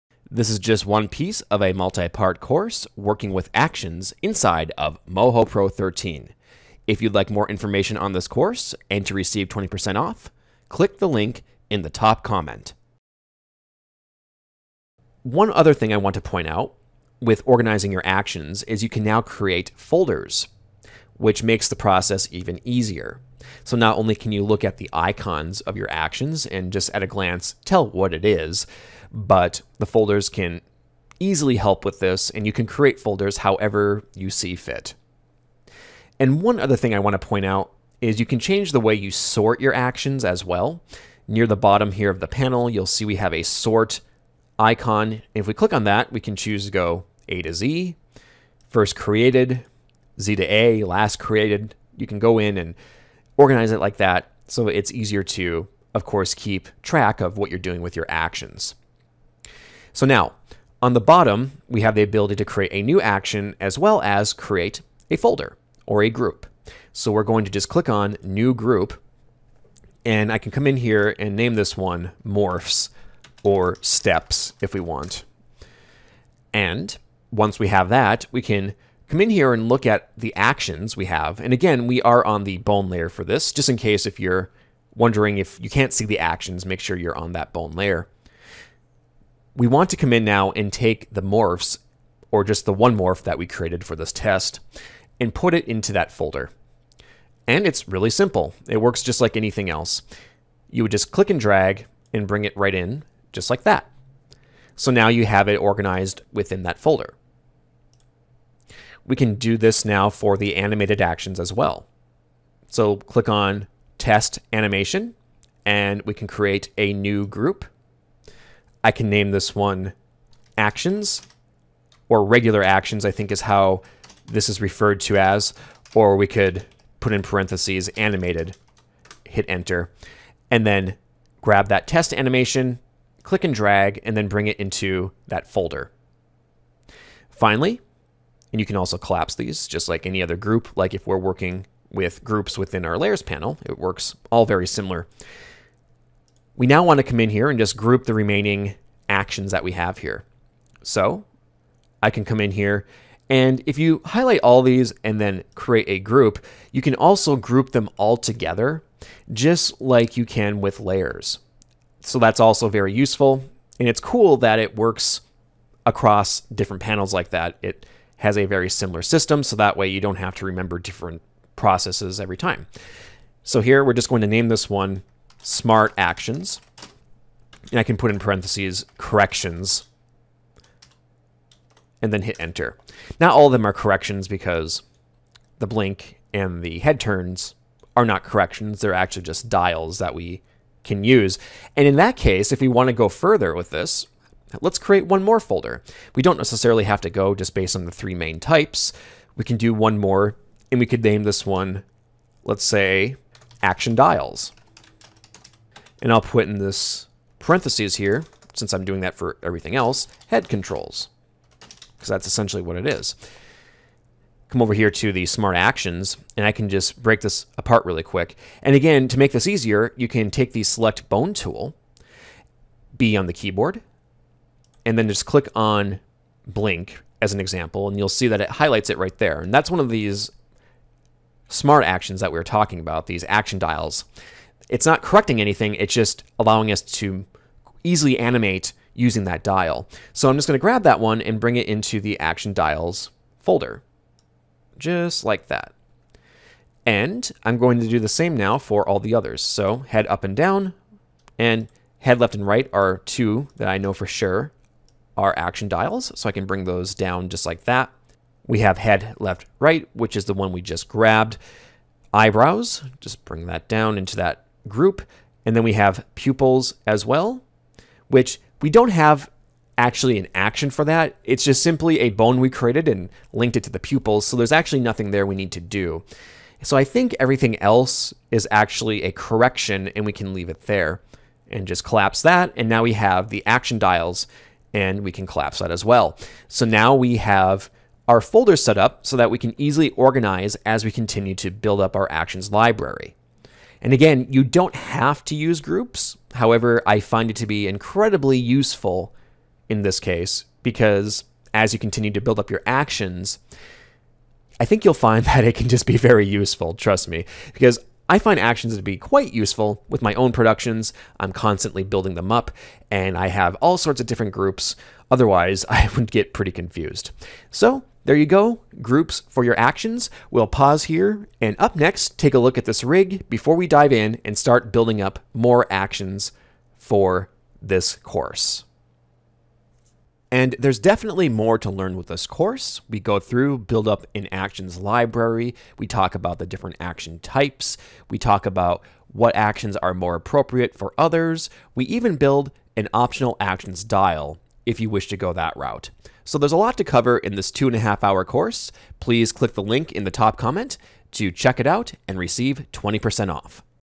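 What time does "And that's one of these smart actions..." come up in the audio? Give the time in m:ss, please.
3:49.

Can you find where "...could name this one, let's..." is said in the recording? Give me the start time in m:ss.
3:20.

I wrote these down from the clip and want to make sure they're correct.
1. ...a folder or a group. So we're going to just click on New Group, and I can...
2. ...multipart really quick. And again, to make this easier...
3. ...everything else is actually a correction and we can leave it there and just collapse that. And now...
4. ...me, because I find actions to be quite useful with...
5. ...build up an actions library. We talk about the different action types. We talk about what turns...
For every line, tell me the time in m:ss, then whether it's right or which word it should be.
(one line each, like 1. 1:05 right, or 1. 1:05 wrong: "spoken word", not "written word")
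1. 1:05 right
2. 3:37 wrong: "apart", not "multipart"
3. 4:37 right
4. 5:07 right
5. 5:33 wrong: "actions", not "turns".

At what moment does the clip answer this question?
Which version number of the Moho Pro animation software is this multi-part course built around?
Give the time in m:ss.
0:05.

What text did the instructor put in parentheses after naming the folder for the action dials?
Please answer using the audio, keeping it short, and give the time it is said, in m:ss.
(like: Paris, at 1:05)
head controls, at 3:30.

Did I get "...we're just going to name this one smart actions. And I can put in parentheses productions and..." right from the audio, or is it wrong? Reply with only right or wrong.
wrong.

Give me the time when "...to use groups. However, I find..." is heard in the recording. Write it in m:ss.
4:55.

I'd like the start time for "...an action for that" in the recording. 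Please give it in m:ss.
4:30.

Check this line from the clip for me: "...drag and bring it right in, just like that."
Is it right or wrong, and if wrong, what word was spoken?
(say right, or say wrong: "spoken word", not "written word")
right.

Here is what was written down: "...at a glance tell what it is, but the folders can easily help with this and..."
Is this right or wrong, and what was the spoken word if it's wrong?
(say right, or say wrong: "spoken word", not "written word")
right.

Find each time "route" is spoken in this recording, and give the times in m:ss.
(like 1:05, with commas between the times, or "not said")
5:45.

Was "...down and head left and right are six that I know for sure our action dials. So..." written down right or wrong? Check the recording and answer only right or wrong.
wrong.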